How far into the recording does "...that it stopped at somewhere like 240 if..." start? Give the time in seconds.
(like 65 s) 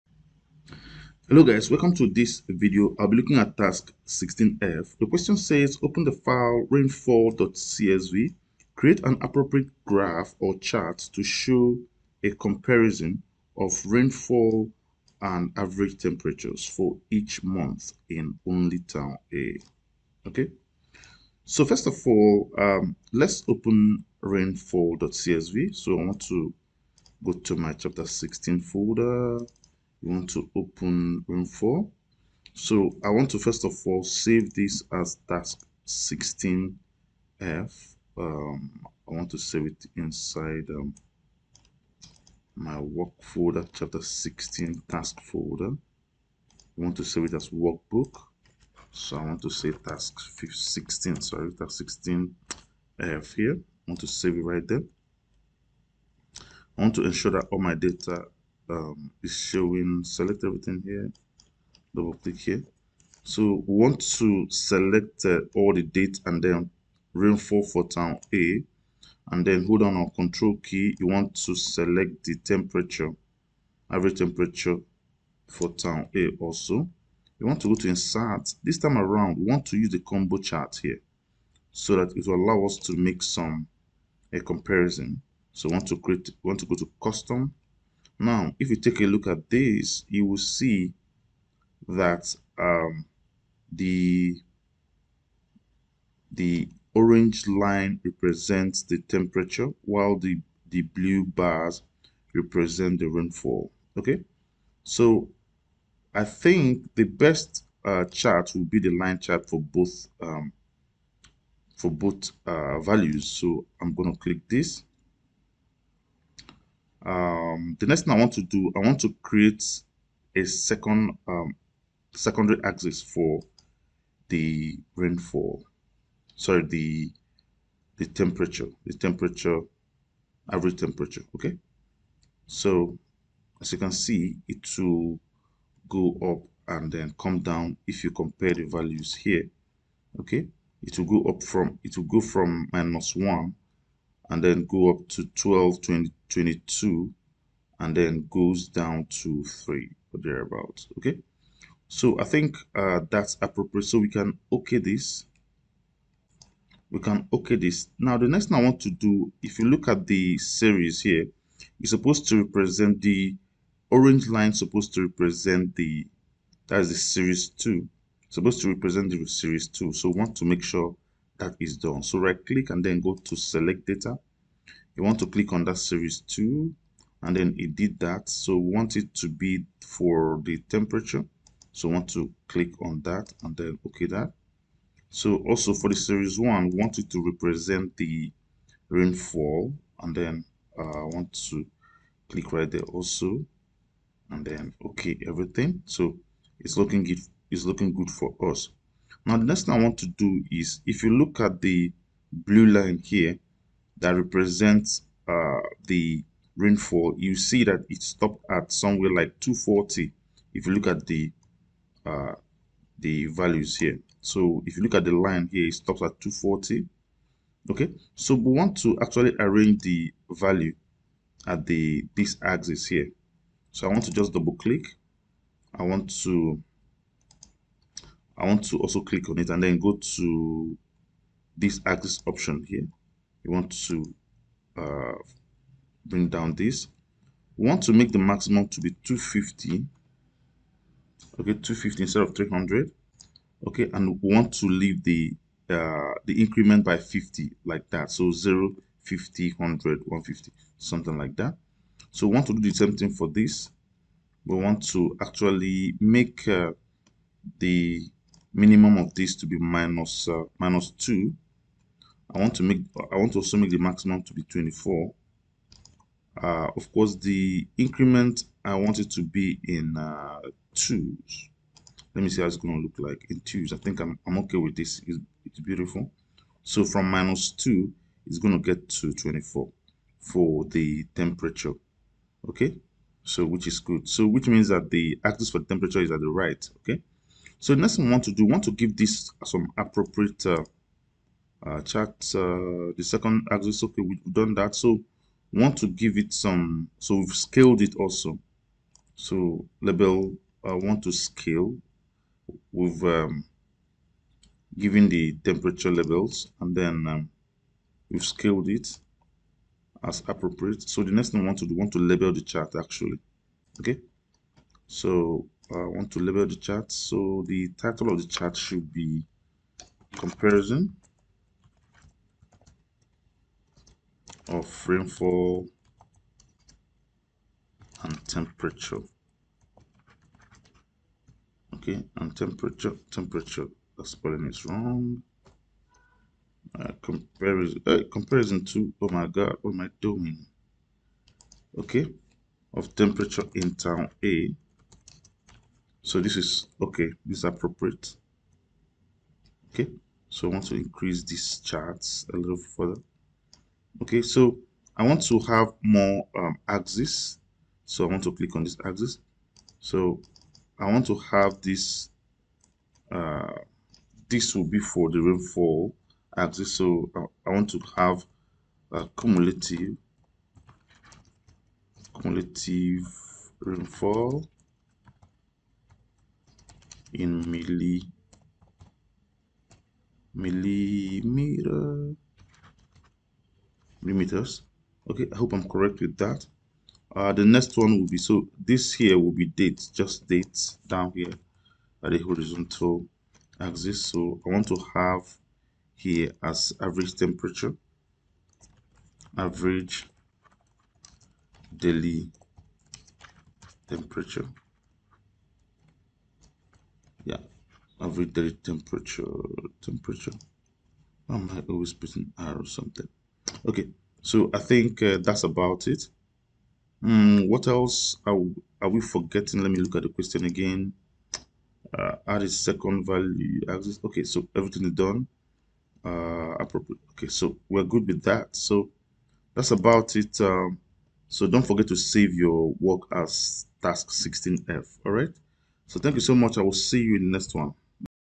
207 s.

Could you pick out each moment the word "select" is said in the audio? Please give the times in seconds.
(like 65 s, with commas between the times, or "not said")
60 s, 64 s, 71 s, 173 s.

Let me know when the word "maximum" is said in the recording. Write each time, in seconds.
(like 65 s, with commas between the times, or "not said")
238 s, 263 s.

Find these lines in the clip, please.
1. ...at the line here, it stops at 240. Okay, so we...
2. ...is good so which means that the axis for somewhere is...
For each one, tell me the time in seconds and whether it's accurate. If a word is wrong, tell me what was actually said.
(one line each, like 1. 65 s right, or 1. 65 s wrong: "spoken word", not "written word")
1. 214 s right
2. 283 s wrong: "temperature", not "somewhere".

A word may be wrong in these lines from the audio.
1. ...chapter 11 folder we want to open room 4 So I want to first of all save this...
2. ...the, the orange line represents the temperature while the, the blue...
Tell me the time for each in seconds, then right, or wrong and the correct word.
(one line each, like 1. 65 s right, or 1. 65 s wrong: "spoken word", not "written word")
1. 27 s wrong: "16", not "11"
2. 93 s right.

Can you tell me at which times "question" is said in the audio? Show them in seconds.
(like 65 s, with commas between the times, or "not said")
5 s, 420 s.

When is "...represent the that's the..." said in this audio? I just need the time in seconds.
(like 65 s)
165 s.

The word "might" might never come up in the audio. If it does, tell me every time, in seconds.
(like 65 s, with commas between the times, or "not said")
411 s.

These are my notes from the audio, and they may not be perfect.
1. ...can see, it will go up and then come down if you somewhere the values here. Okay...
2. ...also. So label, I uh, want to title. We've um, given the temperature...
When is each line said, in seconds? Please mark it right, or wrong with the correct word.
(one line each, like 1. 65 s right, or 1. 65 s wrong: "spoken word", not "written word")
1. 133 s wrong: "compare", not "somewhere"
2. 297 s wrong: "scale", not "title".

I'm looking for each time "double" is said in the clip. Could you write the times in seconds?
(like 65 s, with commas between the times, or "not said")
61 s, 224 s.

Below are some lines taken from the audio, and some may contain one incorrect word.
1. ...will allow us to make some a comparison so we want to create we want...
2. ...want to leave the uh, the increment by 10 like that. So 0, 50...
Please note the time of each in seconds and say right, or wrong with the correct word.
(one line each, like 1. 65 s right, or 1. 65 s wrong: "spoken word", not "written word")
1. 82 s right
2. 244 s wrong: "50", not "10".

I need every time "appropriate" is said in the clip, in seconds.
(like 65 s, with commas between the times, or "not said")
9 s, 153 s, 289 s, 310 s, 347 s, 426 s.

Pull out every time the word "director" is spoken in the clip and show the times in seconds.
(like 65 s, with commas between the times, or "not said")
not said.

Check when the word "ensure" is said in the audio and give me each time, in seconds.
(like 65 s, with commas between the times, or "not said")
57 s.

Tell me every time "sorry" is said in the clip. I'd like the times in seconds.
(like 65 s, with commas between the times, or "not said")
51 s, 126 s.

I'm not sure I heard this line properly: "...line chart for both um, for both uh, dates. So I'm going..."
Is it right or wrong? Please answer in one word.
wrong.